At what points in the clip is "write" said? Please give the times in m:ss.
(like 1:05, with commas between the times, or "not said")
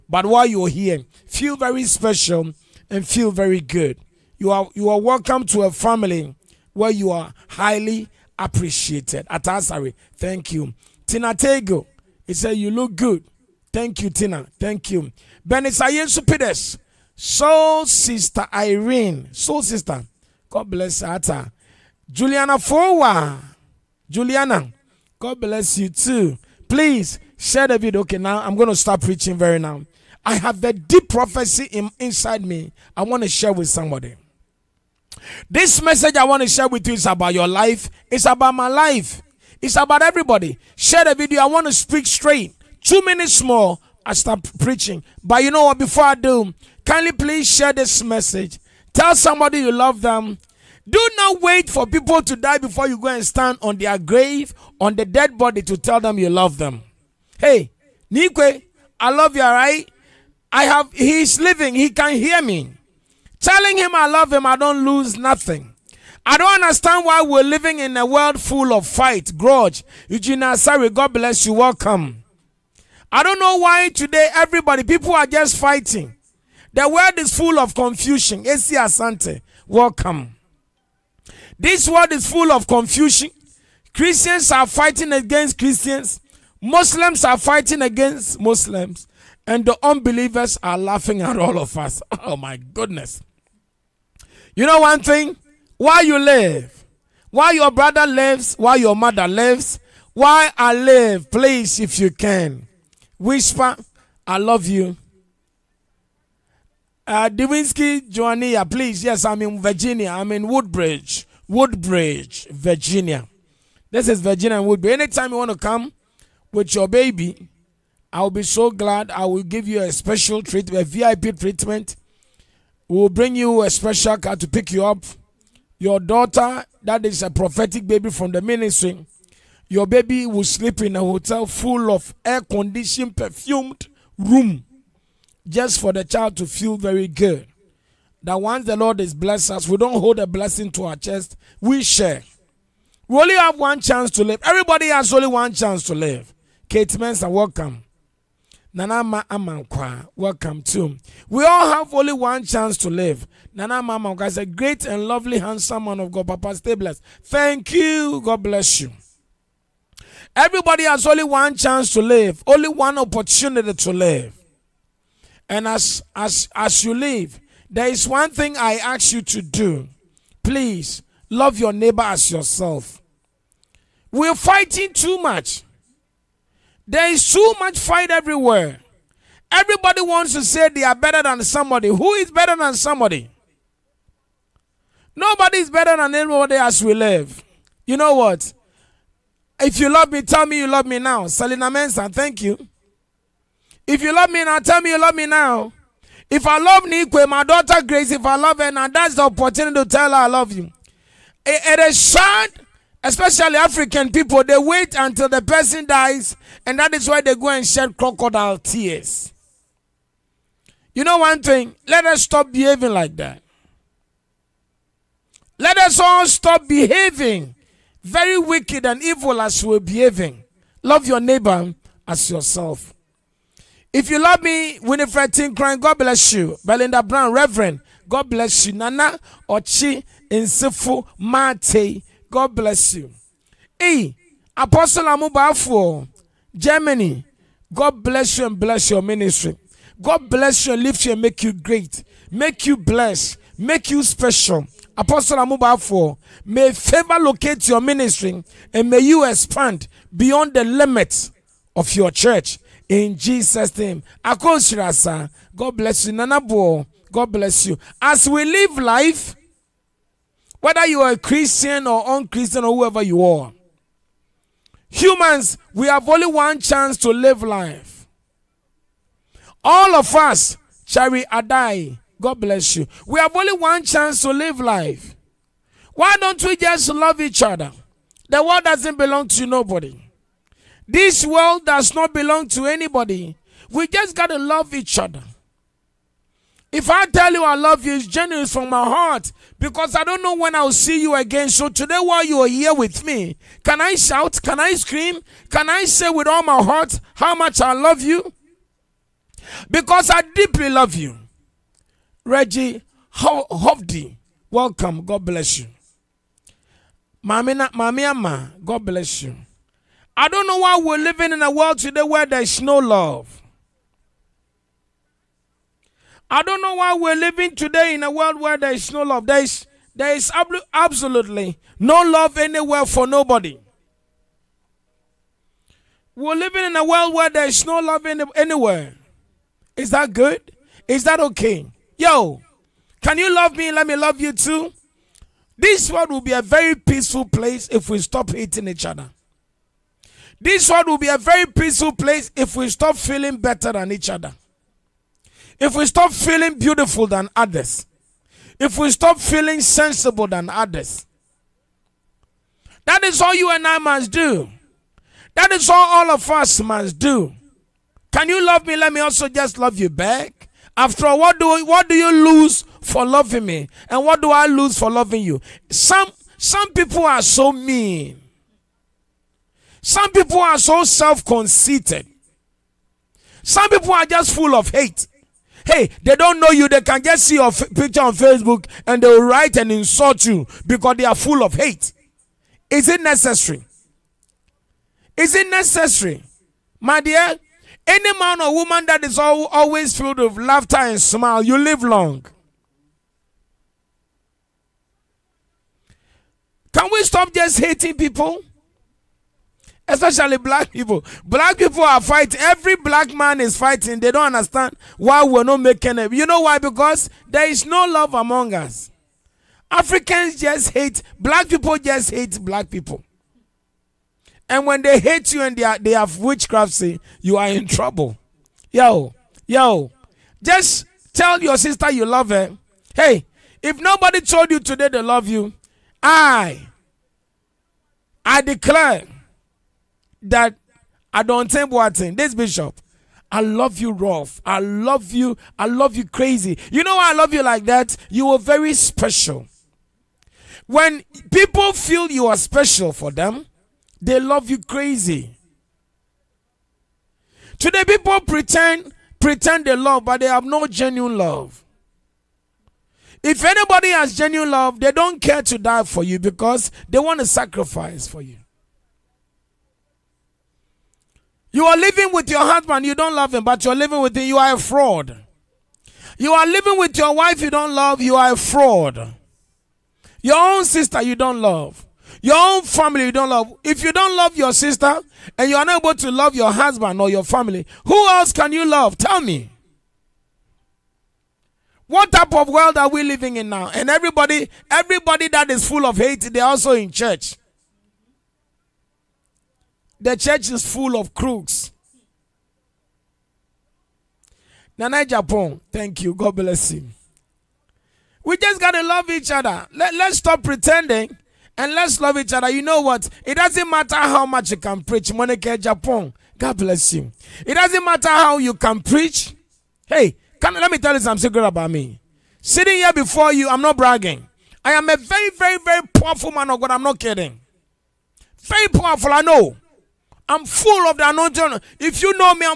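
6:19.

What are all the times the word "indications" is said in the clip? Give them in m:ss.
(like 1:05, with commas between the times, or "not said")
not said.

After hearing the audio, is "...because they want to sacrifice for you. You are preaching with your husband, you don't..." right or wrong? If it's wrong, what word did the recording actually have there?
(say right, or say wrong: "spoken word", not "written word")
wrong: "living", not "preaching".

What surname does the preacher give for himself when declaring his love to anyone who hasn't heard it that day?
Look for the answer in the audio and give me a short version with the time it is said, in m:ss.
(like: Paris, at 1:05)
Boateng, at 7:11.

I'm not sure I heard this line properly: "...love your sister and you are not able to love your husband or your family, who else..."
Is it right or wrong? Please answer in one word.
right.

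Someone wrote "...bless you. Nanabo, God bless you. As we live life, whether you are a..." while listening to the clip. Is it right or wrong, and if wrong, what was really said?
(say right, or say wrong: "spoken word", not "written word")
right.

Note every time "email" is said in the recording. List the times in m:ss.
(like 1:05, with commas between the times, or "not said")
not said.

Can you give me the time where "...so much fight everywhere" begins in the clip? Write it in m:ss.
2:57.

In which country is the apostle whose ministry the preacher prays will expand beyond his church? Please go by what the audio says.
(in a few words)
Germany.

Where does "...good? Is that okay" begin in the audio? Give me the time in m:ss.
5:30.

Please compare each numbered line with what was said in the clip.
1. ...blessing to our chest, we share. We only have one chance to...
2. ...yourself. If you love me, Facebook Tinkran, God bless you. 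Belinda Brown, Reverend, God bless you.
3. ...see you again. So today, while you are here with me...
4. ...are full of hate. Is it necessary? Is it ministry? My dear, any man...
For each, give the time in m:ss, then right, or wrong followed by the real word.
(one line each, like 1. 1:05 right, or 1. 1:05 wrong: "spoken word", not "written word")
1. 2:20 right
2. 3:42 wrong: "Winifred", not "Facebook"
3. 4:50 right
4. 6:21 wrong: "necessary", not "ministry".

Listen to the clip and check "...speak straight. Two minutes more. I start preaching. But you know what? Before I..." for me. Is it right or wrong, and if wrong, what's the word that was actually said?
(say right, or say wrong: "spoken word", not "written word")
right.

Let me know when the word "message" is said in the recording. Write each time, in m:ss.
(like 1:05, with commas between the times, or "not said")
0:35, 0:48.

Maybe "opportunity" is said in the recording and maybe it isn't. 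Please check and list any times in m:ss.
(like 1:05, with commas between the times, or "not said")
2:42, 3:19.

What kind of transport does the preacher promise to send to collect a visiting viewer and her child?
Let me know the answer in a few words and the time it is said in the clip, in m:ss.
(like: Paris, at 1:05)
A special car, at 2:03.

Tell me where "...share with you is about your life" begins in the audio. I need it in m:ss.
0:36.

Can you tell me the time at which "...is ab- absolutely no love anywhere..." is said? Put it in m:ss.
5:20.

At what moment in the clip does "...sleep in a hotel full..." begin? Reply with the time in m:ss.
2:10.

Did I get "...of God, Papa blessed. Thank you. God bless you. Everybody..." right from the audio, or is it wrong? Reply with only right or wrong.
right.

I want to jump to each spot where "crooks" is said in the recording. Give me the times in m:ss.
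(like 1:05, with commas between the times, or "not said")
8:11.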